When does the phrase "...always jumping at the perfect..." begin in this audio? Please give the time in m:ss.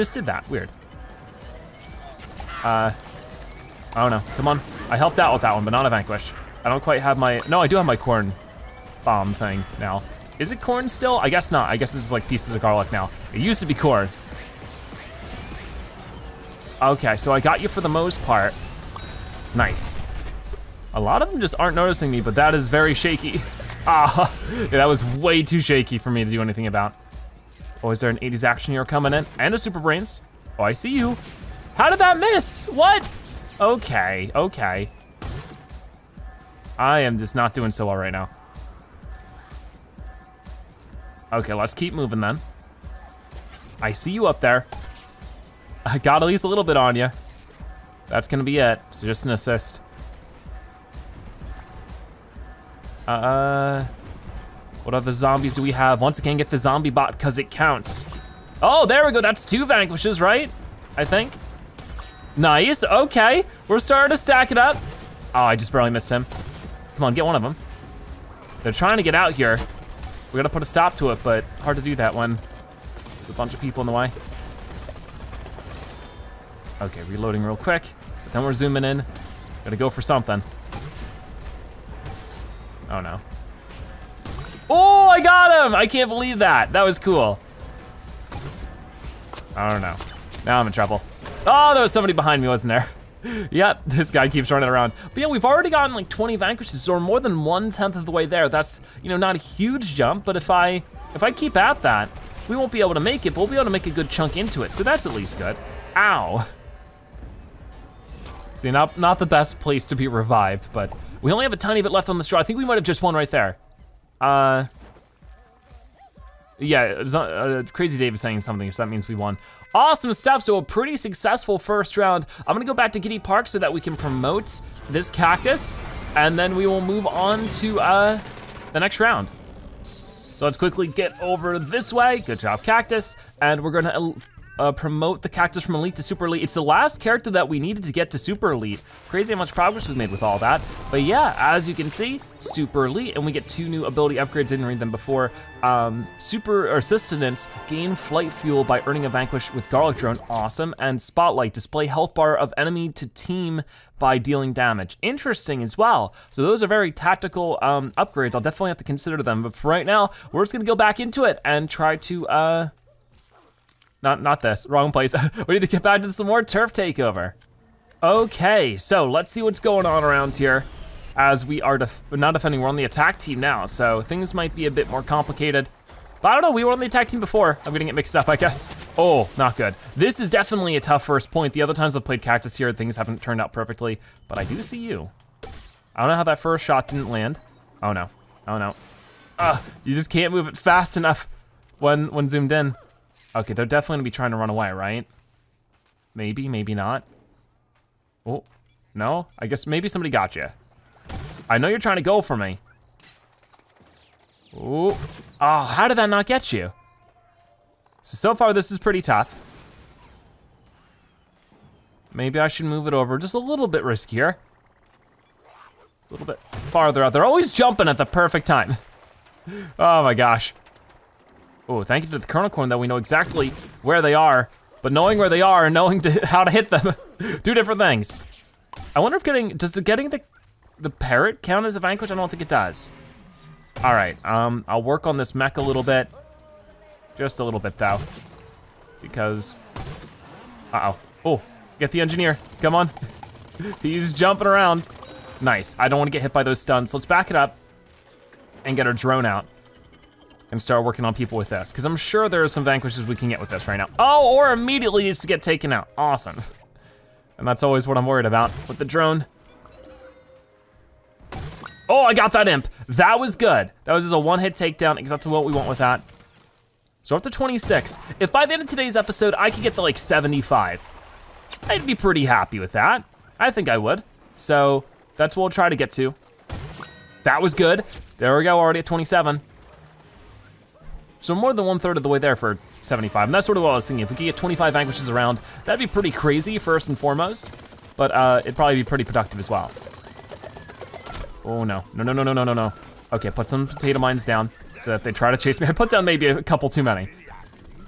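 3:37.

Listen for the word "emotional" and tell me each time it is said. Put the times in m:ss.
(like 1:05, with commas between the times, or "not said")
not said.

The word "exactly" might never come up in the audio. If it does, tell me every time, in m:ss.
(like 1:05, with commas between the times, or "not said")
3:42, 4:24.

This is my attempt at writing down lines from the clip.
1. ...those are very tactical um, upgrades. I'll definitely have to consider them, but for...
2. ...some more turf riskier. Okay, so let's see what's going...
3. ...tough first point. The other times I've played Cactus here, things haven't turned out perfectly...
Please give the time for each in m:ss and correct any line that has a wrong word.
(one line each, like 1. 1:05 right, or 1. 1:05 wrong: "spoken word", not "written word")
1. 2:36 right
2. 2:46 wrong: "takeover", not "riskier"
3. 3:00 right.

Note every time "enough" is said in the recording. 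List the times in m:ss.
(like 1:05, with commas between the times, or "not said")
3:10.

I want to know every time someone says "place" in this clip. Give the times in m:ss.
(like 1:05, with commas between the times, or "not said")
1:49, 2:44.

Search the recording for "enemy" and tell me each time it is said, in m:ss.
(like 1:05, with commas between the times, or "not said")
2:32.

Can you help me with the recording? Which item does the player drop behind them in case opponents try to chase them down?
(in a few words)
potato mines.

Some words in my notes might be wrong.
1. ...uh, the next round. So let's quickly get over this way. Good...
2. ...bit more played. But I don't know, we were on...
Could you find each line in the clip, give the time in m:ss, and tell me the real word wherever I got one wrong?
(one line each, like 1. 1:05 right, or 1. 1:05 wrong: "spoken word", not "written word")
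1. 2:07 right
2. 2:54 wrong: "complicated", not "played".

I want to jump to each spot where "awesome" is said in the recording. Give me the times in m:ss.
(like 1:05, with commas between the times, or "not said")
1:59, 2:30, 4:15.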